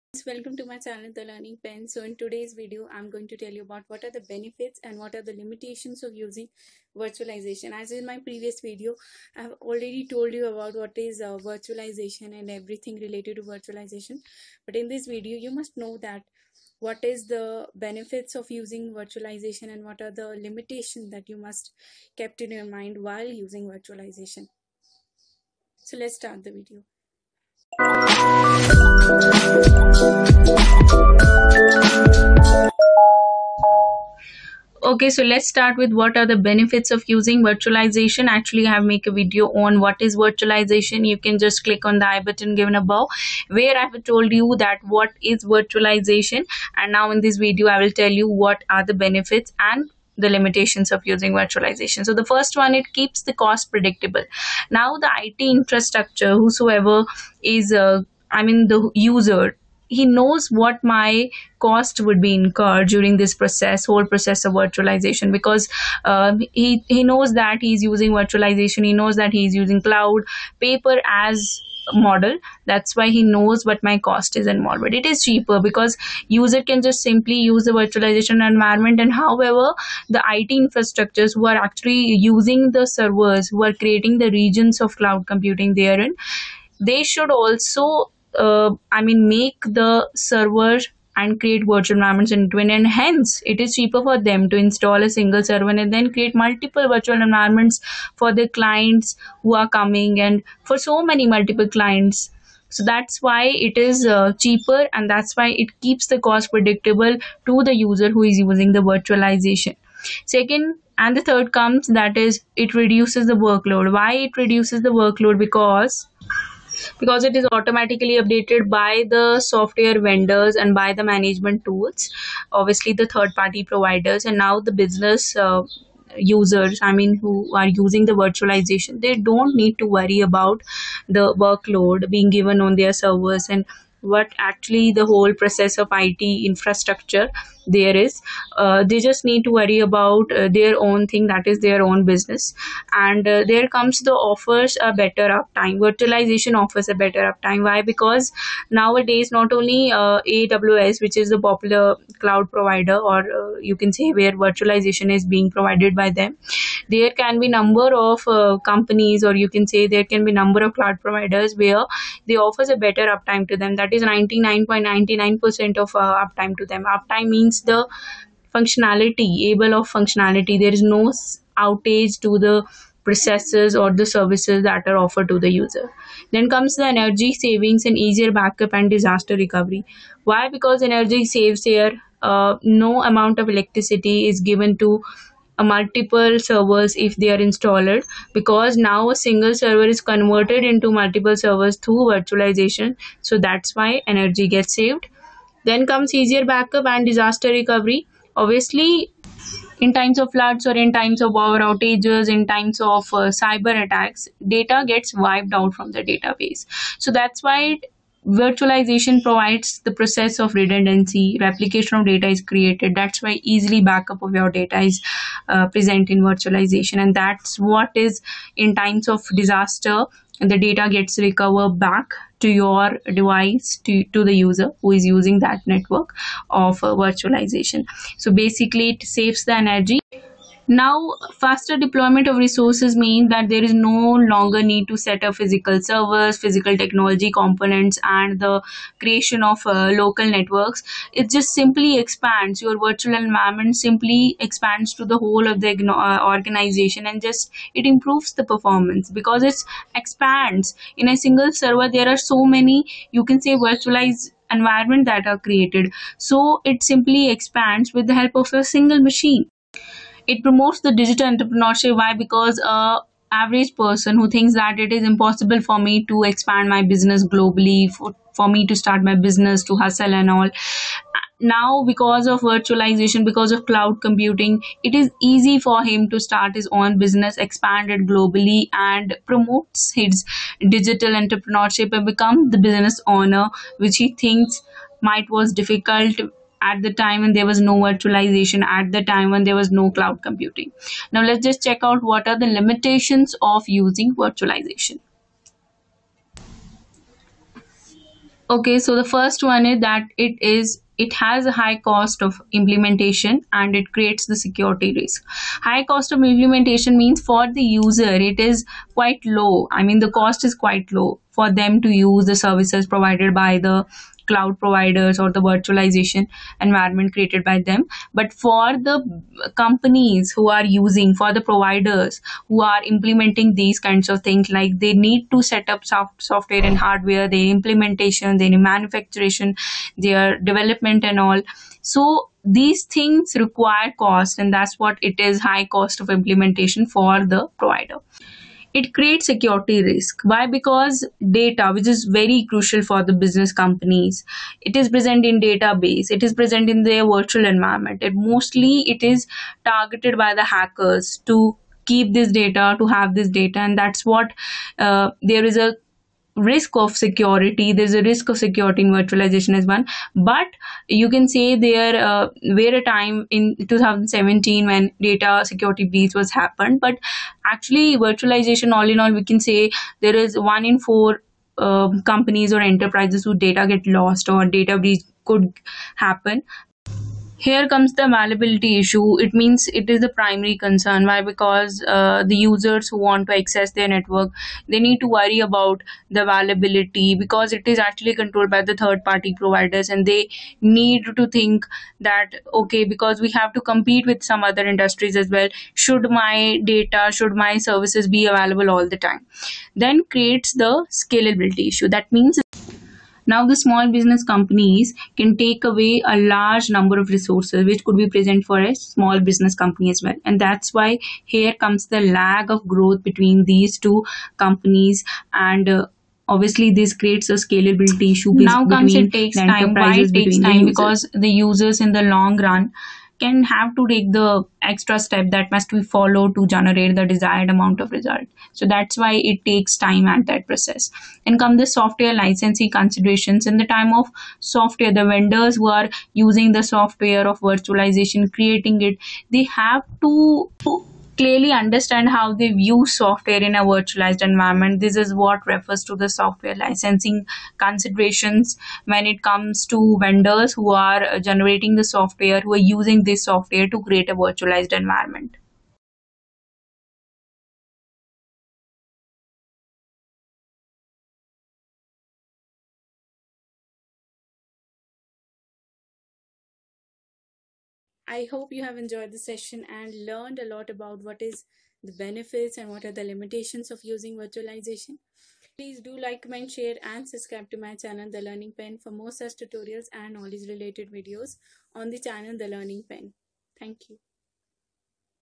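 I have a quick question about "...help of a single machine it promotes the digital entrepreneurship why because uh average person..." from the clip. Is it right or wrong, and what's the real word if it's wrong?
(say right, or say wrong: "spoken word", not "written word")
right.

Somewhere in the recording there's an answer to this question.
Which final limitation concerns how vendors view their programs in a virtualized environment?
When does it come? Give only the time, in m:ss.
7:26.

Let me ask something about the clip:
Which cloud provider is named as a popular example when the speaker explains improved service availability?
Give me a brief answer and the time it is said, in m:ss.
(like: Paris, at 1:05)
AWS, at 2:30.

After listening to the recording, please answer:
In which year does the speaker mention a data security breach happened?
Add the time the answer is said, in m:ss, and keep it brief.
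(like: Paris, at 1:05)
2017, at 6:03.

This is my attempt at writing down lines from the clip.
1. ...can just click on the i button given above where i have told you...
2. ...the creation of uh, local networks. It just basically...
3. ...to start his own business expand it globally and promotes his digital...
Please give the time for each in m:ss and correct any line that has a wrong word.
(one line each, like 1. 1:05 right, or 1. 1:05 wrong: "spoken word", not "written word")
1. 0:41 right
2. 3:58 wrong: "simply", not "basically"
3. 4:36 right.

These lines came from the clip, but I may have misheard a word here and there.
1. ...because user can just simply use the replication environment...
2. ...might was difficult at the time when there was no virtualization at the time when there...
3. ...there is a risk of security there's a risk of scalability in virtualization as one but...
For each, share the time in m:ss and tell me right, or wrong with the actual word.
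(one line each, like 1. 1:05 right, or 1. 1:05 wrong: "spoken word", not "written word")
1. 1:15 wrong: "virtualization", not "replication"
2. 4:45 right
3. 5:55 wrong: "security", not "scalability".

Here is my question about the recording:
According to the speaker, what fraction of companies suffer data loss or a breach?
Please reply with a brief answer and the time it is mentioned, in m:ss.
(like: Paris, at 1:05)
one in four, at 6:10.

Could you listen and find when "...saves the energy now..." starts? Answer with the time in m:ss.
3:49.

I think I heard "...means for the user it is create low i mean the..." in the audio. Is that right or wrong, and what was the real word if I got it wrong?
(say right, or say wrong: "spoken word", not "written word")
wrong: "quite", not "create".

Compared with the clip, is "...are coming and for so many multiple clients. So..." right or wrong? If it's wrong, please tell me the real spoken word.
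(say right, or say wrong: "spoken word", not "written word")
right.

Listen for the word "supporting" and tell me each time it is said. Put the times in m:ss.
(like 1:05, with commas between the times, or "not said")
not said.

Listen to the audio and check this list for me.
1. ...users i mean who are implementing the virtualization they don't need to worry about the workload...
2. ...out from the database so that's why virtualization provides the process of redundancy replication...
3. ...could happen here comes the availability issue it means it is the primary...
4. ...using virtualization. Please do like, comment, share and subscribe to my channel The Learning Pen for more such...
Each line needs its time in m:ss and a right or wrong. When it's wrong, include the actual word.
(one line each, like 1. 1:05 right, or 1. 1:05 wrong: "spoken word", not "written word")
1. 2:06 wrong: "using", not "implementing"
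2. 3:25 right
3. 6:15 right
4. 7:53 right.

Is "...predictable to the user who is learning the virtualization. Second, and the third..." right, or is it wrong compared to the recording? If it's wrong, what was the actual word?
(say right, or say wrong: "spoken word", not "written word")
wrong: "using", not "learning".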